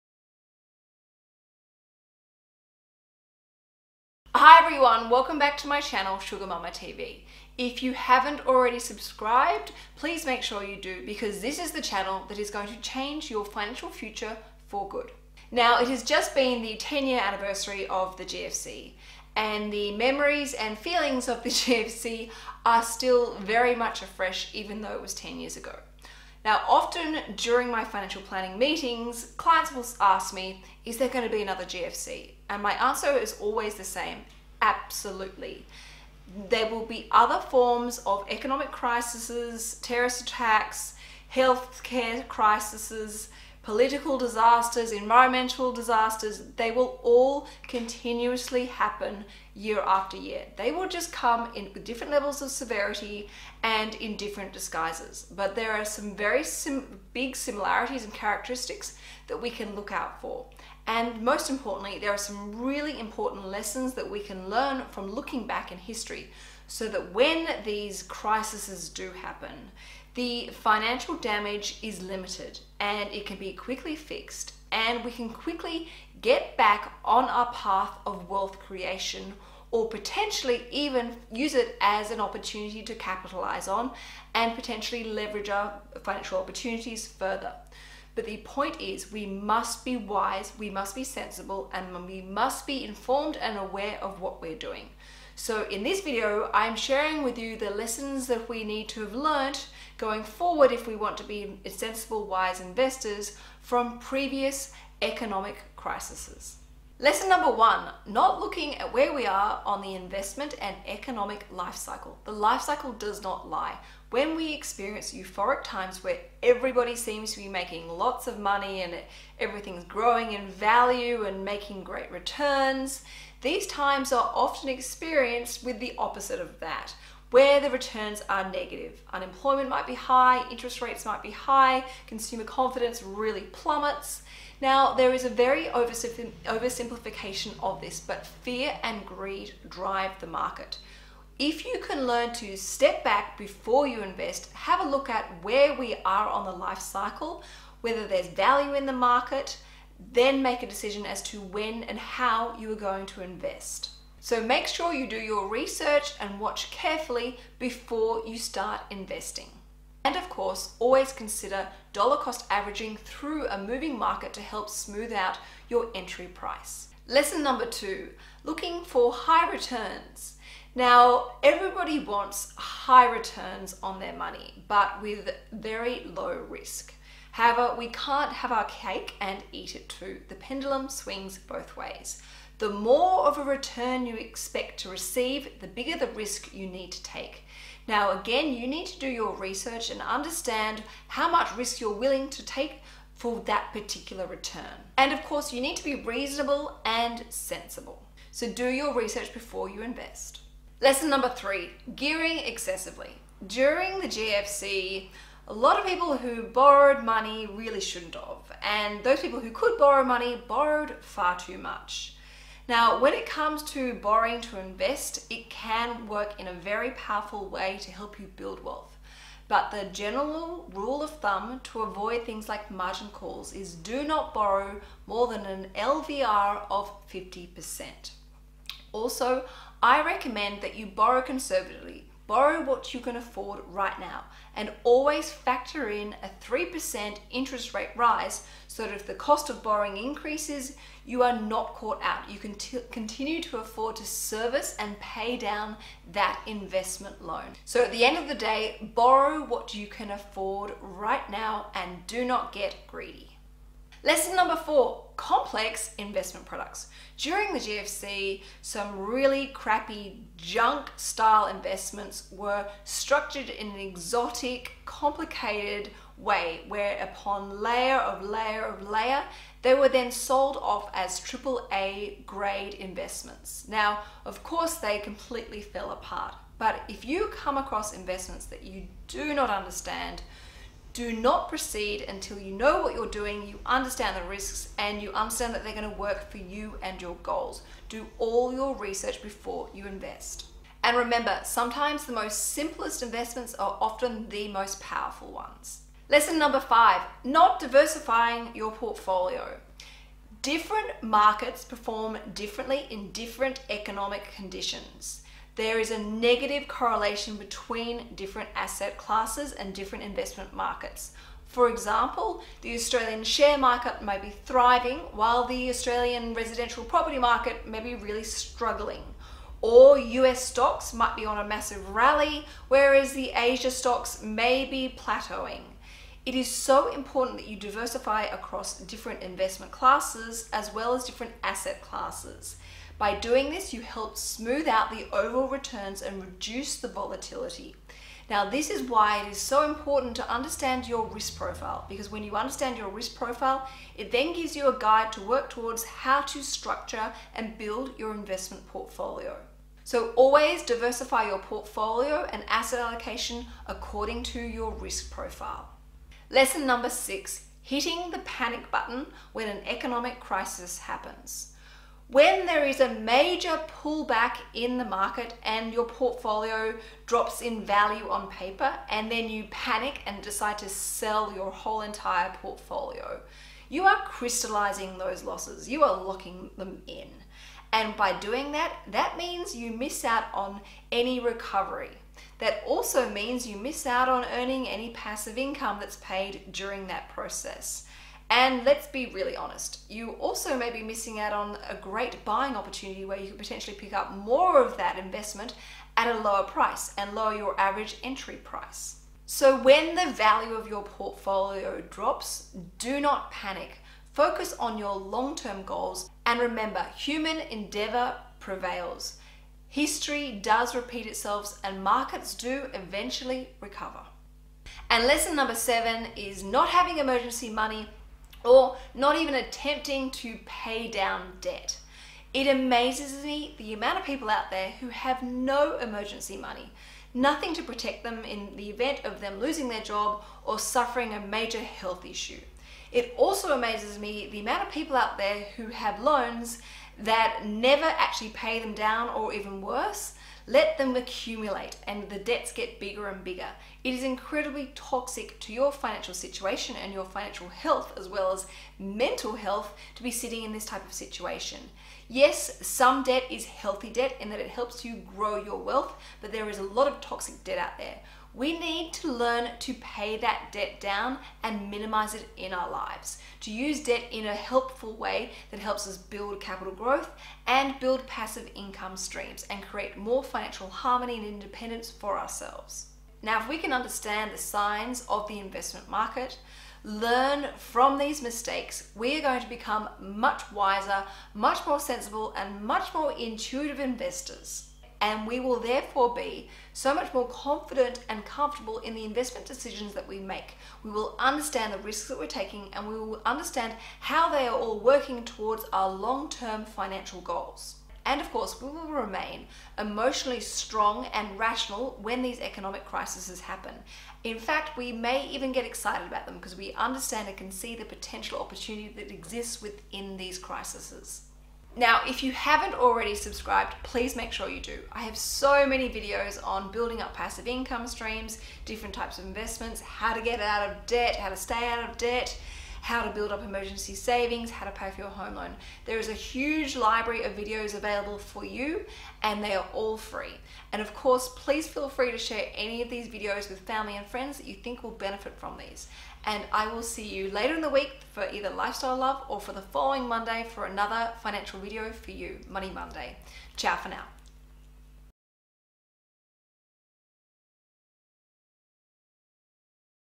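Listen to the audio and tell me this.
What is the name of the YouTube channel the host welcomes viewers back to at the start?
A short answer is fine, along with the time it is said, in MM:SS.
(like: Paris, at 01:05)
Sugar Mamma TV, at 00:06.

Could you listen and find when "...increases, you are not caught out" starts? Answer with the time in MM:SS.
03:59.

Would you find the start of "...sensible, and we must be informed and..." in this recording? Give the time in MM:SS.
01:31.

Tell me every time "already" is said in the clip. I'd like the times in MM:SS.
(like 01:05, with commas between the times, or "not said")
00:08, 08:32.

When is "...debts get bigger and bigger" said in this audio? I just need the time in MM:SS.
07:22.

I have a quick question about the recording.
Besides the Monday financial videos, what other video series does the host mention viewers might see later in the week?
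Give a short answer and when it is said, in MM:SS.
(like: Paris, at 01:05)
Lifestyle Love, at 08:58.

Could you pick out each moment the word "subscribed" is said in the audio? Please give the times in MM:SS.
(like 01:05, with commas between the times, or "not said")
00:08, 08:33.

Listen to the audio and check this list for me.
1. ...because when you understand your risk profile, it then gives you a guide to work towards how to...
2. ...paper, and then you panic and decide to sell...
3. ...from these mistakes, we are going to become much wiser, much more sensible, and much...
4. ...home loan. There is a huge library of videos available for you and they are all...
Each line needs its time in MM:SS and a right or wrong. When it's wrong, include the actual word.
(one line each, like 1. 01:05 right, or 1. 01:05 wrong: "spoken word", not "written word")
1. 05:41 right
2. 06:08 right
3. 07:57 right
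4. 08:45 right.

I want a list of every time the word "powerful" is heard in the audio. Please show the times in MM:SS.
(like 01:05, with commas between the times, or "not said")
03:36, 04:54.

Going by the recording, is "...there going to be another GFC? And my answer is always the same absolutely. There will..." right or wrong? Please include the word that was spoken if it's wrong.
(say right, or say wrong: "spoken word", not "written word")
right.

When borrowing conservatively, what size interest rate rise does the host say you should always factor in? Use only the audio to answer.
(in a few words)
3%.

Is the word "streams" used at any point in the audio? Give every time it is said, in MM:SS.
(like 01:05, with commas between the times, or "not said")
07:48, 08:37.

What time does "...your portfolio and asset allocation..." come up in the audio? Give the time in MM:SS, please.
05:51.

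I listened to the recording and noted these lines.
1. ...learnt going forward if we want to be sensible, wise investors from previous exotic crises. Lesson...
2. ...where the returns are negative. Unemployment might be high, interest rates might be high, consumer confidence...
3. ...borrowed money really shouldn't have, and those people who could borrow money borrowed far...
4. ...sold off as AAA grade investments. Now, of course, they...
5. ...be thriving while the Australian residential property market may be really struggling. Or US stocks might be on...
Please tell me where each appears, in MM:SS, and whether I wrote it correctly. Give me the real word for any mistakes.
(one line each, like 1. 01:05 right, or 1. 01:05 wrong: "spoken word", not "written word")
1. 01:39 wrong: "economic", not "exotic"
2. 02:07 right
3. 03:26 right
4. 04:30 right
5. 05:14 right.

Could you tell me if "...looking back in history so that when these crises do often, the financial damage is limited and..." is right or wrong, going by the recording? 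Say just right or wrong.
wrong.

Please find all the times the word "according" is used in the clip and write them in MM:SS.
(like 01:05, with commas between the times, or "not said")
05:53.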